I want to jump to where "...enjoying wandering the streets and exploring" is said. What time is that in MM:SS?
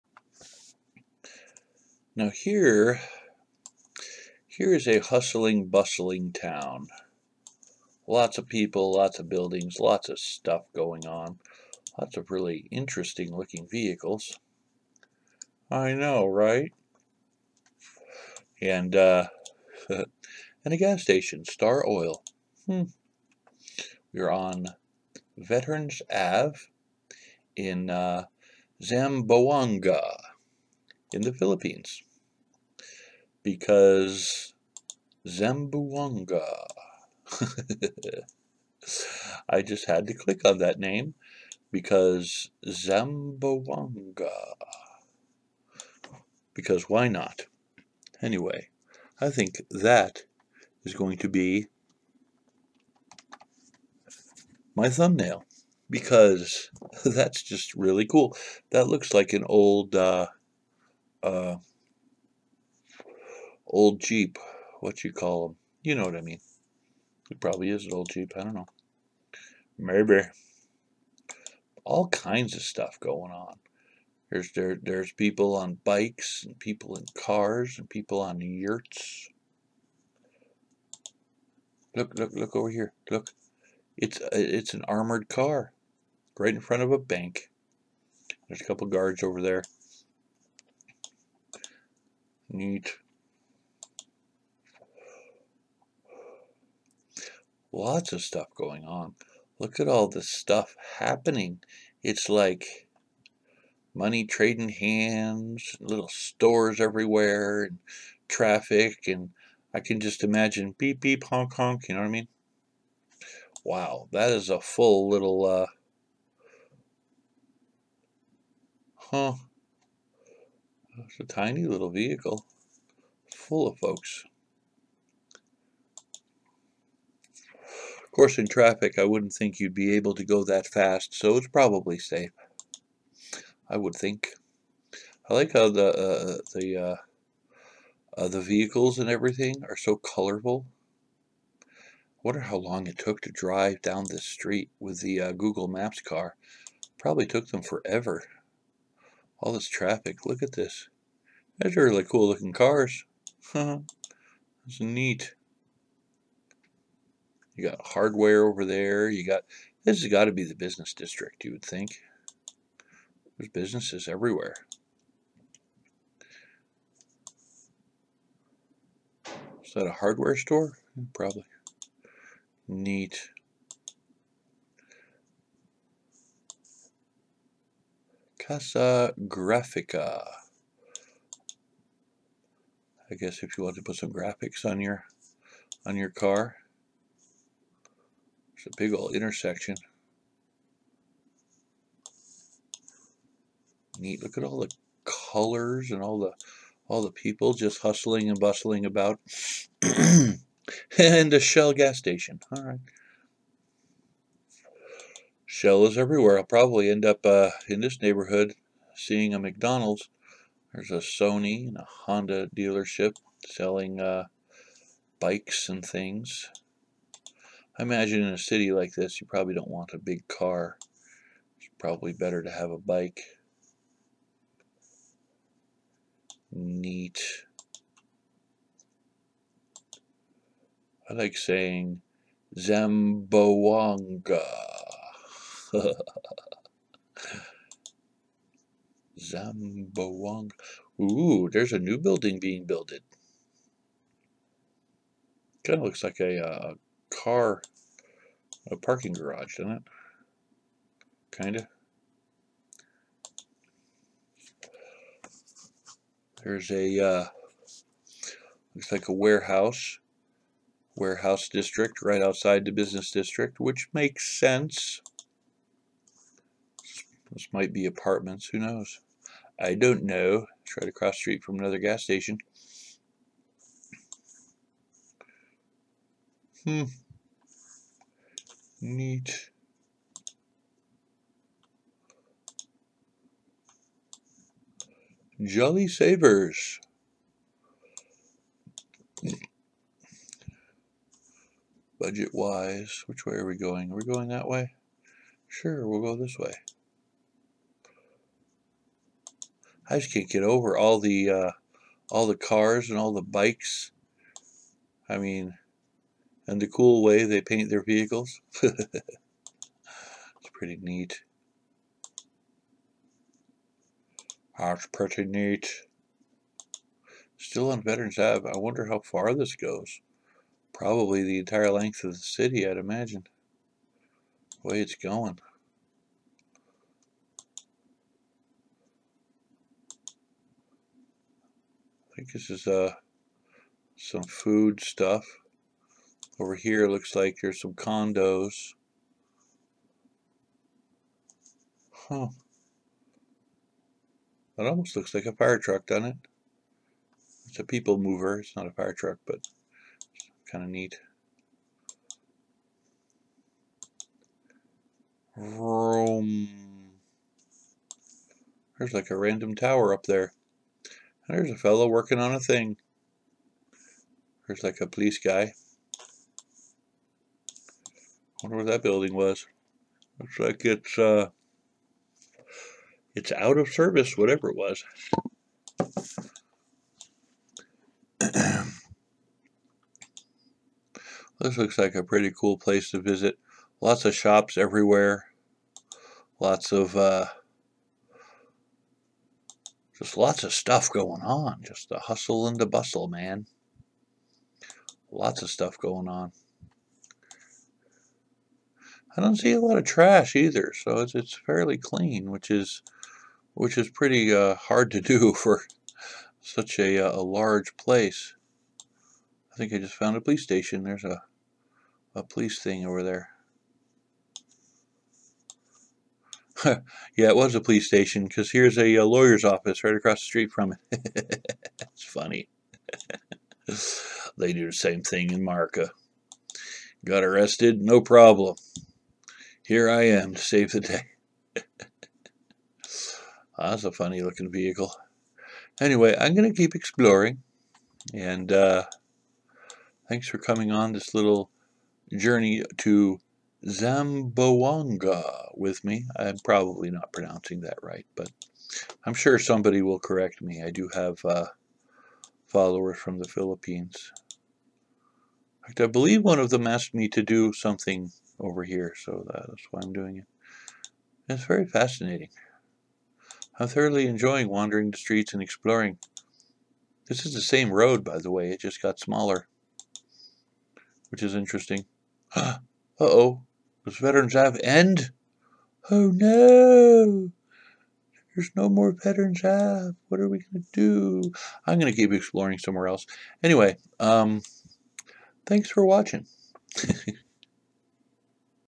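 07:44.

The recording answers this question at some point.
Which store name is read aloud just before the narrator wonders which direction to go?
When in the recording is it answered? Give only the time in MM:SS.
04:45.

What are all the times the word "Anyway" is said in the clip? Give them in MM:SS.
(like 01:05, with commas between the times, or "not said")
00:48, 07:15, 08:03.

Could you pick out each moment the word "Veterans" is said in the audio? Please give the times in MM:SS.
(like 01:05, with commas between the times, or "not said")
00:25, 05:17, 07:53, 07:58.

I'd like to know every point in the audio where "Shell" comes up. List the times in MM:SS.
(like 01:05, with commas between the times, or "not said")
03:21, 03:25.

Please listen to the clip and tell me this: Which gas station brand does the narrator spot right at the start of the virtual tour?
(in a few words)
Star Oil.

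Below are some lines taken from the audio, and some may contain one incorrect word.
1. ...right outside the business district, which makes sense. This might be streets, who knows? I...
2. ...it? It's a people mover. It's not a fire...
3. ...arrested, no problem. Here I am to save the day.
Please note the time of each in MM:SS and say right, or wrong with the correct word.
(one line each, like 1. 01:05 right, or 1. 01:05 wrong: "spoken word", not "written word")
1. 04:22 wrong: "apartments", not "streets"
2. 05:46 right
3. 07:07 right.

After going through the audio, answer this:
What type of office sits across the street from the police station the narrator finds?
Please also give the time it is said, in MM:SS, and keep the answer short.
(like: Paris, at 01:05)
lawyer's office, at 06:59.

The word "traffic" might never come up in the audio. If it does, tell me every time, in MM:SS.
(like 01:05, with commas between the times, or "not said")
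01:48, 02:08, 02:29.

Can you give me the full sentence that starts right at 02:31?
Those are really cool looking cars.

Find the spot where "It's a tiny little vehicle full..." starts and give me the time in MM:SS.
02:01.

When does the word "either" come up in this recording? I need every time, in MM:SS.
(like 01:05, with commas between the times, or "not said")
06:40.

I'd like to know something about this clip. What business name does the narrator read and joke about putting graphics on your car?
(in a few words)
Casa Grafica.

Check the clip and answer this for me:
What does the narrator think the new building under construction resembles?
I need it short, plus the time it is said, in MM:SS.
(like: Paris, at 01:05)
parking garage, at 04:08.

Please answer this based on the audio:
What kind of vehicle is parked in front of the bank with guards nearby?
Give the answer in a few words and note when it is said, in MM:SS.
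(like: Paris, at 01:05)
armored car, at 01:24.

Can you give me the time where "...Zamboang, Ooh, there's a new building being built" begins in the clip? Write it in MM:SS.
03:59.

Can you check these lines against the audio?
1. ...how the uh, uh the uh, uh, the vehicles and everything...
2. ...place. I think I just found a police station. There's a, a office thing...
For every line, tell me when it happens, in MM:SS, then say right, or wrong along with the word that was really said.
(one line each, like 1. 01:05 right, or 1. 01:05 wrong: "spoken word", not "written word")
1. 02:15 right
2. 06:47 wrong: "police", not "office".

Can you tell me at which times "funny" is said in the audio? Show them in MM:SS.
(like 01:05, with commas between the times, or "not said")
07:02, 07:13.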